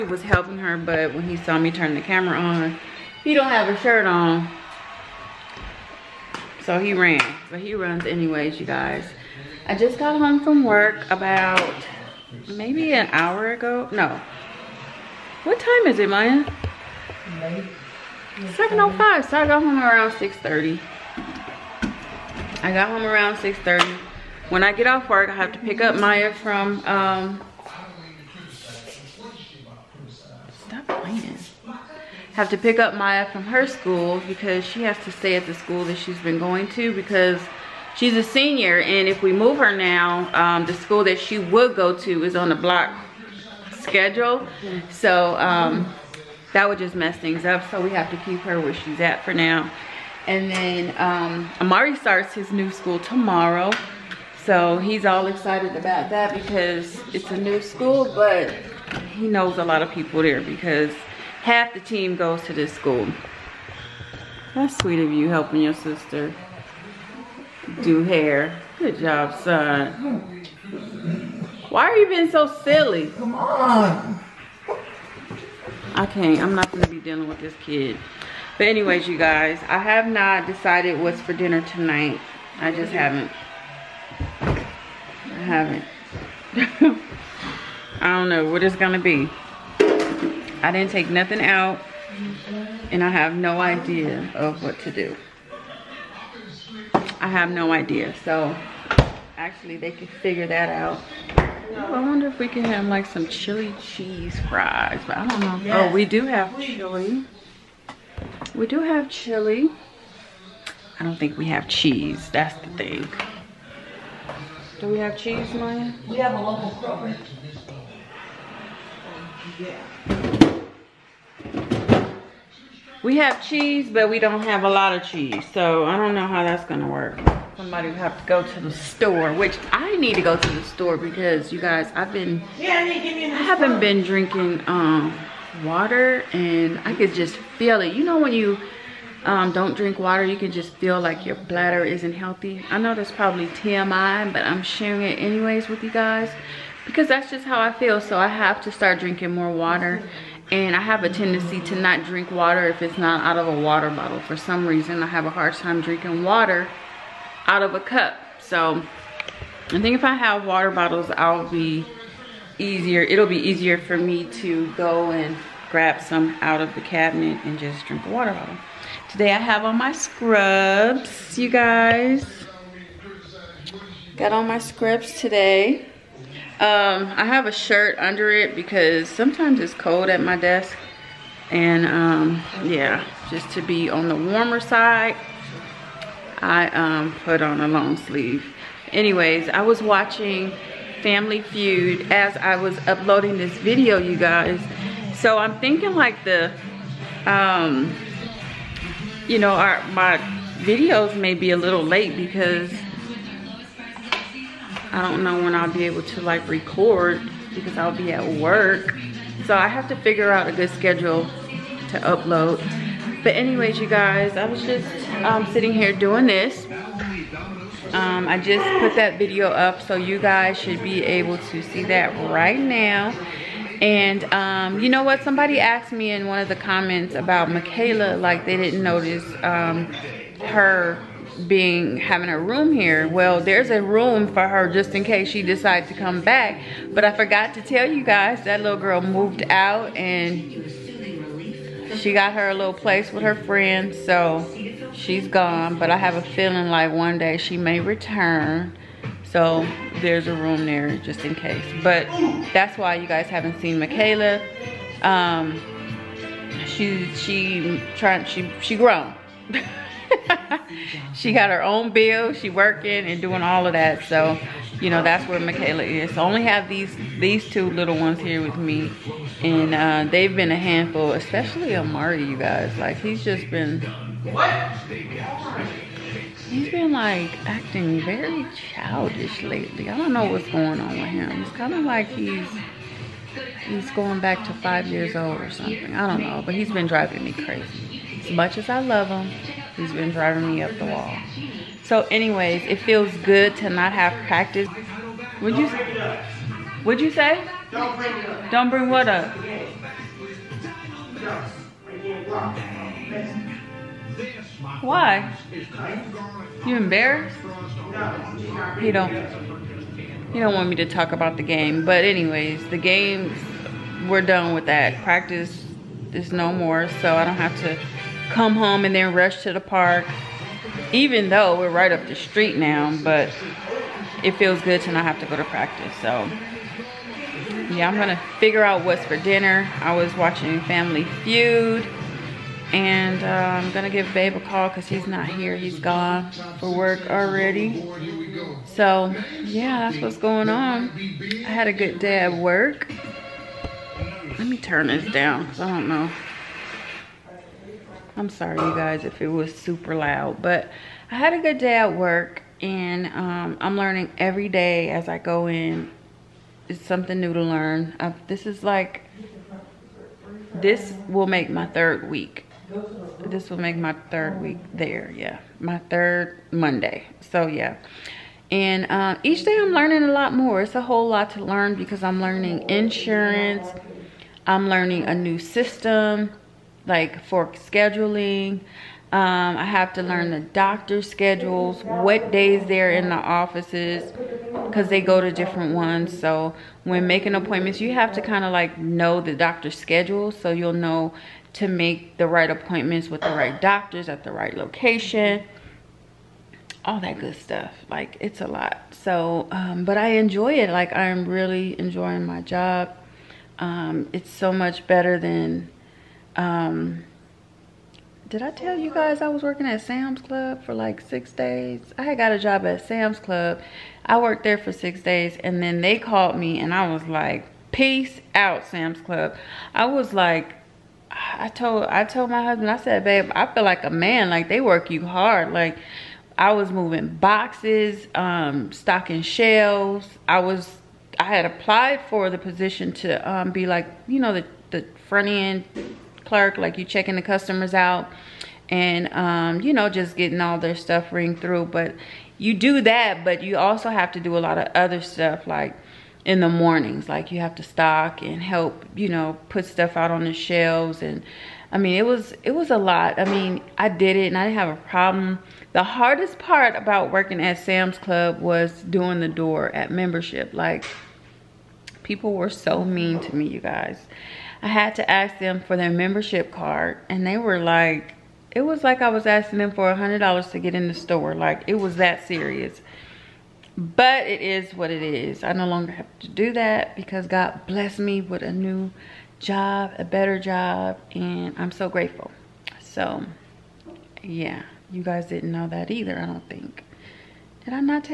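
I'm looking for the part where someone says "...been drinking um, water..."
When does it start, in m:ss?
2:13.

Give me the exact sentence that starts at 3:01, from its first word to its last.
And um, yeah, just to be on the warmer side, I um, put on a long sleeve.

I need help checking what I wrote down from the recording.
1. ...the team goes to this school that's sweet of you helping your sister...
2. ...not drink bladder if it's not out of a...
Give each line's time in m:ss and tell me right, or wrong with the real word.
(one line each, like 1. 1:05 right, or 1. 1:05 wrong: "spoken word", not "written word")
1. 1:01 right
2. 2:31 wrong: "water", not "bladder".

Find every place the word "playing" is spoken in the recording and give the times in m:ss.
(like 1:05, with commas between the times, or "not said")
0:31.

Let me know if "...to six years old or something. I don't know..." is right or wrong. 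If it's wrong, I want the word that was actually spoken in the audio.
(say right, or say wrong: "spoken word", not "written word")
wrong: "five", not "six".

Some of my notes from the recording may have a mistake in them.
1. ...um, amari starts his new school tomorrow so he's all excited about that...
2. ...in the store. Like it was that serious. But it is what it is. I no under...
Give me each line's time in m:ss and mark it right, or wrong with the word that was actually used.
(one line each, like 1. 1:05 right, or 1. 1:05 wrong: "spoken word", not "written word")
1. 0:50 right
2. 7:50 wrong: "longer", not "under".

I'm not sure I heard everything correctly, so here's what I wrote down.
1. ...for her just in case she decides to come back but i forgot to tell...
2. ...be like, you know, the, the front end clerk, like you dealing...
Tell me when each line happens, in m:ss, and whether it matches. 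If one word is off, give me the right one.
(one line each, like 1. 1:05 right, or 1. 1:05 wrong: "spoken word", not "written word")
1. 3:54 right
2. 7:13 wrong: "checking", not "dealing".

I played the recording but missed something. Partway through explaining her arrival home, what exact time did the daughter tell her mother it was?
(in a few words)
7.05.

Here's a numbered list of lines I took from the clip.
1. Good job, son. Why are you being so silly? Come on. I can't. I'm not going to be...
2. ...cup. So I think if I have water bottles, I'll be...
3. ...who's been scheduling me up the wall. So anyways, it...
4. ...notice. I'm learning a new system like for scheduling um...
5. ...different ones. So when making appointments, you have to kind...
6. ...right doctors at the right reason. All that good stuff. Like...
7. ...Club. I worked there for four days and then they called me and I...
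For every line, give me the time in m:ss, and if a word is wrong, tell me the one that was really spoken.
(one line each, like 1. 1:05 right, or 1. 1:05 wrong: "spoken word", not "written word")
1. 1:08 right
2. 2:37 right
3. 4:49 wrong: "driving", not "scheduling"
4. 6:12 wrong: "insurance", not "notice"
5. 6:25 right
6. 6:33 wrong: "location", not "reason"
7. 6:53 wrong: "six", not "four".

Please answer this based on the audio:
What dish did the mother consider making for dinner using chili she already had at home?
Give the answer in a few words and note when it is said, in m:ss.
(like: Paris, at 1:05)
Chili cheese fries, at 1:43.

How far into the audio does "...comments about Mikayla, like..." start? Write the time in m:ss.
3:46.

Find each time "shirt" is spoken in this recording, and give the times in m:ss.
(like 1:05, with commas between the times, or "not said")
0:03, 2:57.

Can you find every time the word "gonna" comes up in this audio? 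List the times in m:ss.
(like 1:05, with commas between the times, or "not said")
2:06, 5:27, 5:33.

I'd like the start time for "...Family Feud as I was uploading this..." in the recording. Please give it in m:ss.
3:11.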